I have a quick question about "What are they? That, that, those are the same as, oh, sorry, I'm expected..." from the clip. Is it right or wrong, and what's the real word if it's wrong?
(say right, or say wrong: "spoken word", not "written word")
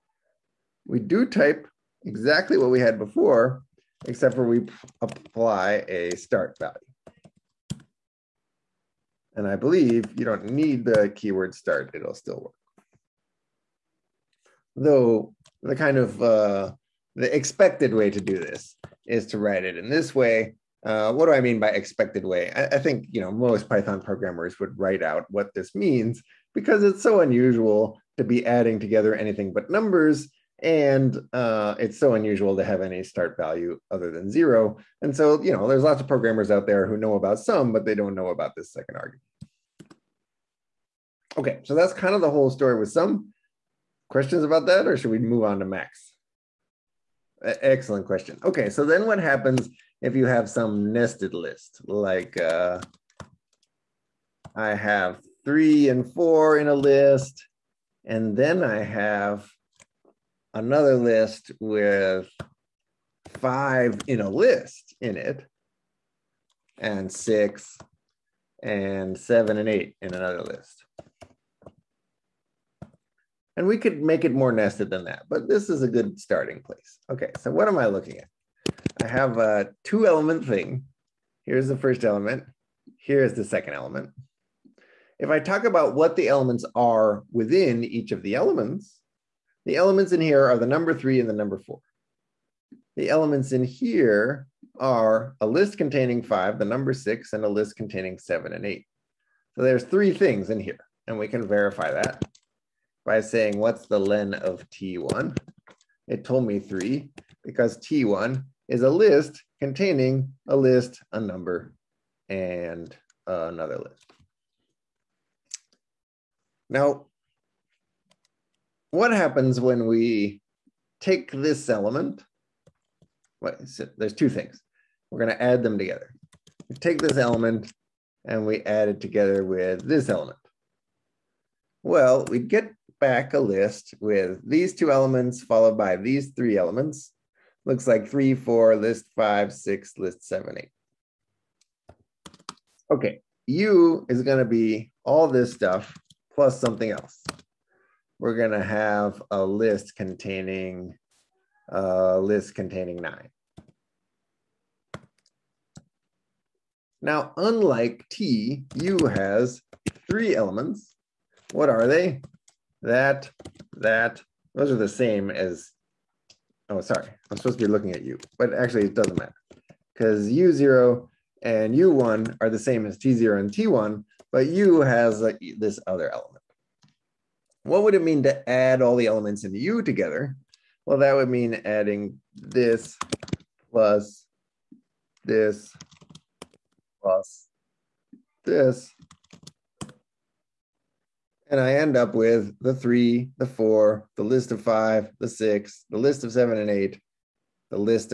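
wrong: "supposed", not "expected".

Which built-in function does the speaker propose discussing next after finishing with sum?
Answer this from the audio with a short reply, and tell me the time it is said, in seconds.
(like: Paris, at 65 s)
max, at 45 s.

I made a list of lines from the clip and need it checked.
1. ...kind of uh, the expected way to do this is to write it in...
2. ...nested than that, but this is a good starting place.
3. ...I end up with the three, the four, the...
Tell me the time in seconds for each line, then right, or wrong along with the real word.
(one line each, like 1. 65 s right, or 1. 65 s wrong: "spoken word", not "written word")
1. 15 s right
2. 74 s right
3. 191 s right.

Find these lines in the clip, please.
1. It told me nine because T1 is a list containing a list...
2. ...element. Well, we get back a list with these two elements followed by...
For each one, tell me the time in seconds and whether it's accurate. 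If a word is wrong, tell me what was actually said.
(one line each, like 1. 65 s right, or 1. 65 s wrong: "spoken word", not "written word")
1. 106 s wrong: "three", not "nine"
2. 130 s right.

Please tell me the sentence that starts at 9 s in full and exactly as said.
And I believe you don't need the keyword start, it'll still work.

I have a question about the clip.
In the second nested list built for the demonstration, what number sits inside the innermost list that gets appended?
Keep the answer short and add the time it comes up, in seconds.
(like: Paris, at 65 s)
9, at 152 s.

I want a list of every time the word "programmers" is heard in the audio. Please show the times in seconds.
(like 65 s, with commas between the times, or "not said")
24 s, 36 s.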